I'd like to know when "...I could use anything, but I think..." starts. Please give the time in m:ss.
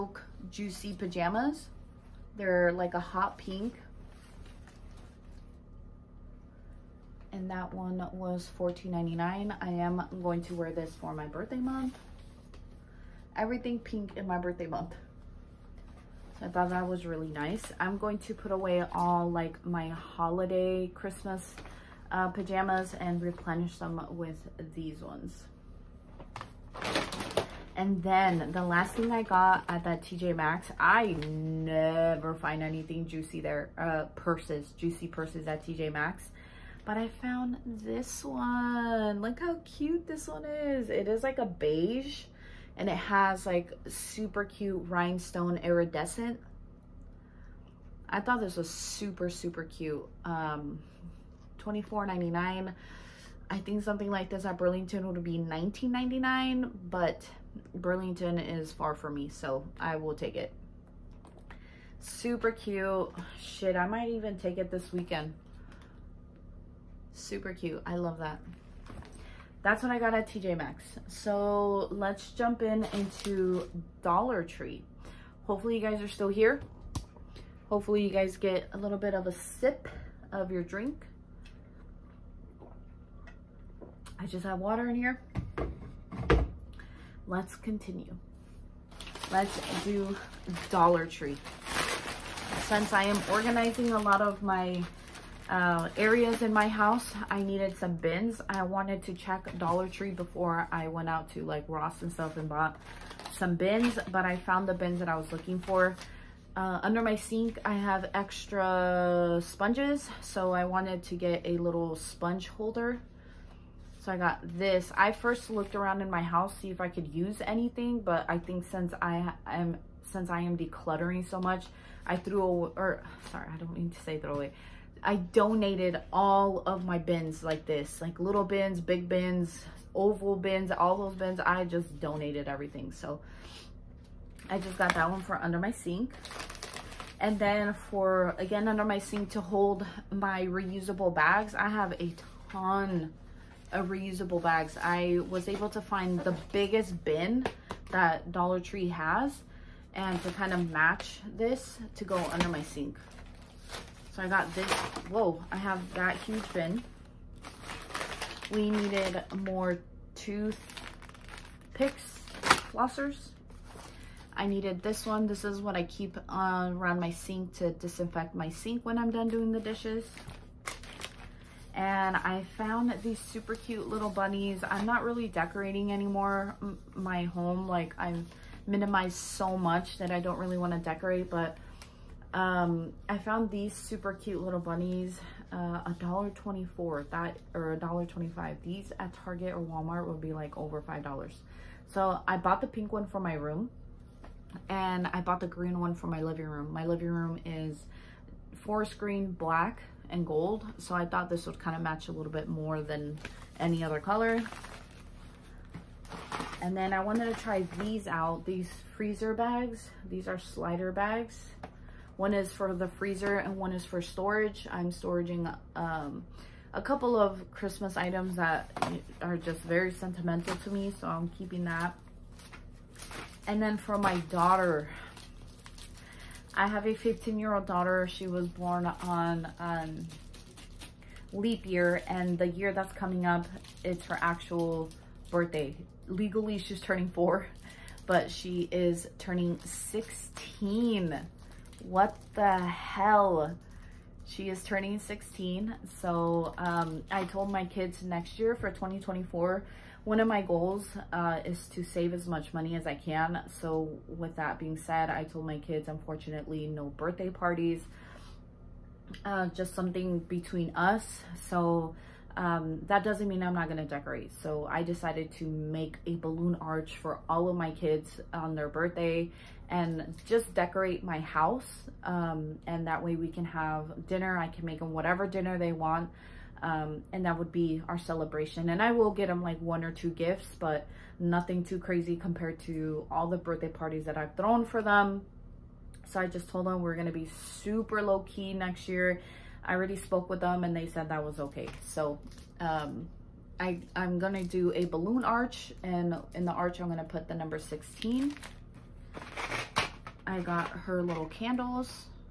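1:56.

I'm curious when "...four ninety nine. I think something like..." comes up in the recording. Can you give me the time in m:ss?
0:51.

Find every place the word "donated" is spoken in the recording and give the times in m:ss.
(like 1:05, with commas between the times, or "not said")
2:05, 2:12.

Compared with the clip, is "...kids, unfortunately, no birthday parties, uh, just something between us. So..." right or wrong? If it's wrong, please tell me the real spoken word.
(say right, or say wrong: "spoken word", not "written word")
right.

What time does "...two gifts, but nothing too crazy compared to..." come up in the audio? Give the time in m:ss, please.
4:39.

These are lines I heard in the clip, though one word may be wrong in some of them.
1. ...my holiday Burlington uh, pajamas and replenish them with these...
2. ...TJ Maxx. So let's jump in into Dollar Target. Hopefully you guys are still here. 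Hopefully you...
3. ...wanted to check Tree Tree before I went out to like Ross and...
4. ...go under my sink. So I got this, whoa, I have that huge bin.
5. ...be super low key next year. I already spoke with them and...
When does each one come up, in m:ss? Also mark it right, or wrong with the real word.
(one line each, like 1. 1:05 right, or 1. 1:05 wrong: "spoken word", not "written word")
1. 0:19 wrong: "Christmas", not "Burlington"
2. 1:10 wrong: "Tree", not "Target"
3. 1:38 wrong: "Dollar", not "Tree"
4. 2:32 right
5. 4:47 right.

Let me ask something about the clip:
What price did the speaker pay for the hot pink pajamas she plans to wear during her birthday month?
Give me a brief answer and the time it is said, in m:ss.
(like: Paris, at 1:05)
$14.99, at 0:08.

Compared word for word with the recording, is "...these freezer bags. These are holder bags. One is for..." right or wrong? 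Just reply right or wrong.
wrong.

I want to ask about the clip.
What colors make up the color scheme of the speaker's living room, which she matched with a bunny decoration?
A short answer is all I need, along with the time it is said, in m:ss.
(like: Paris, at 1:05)
forest green, black and gold, at 3:18.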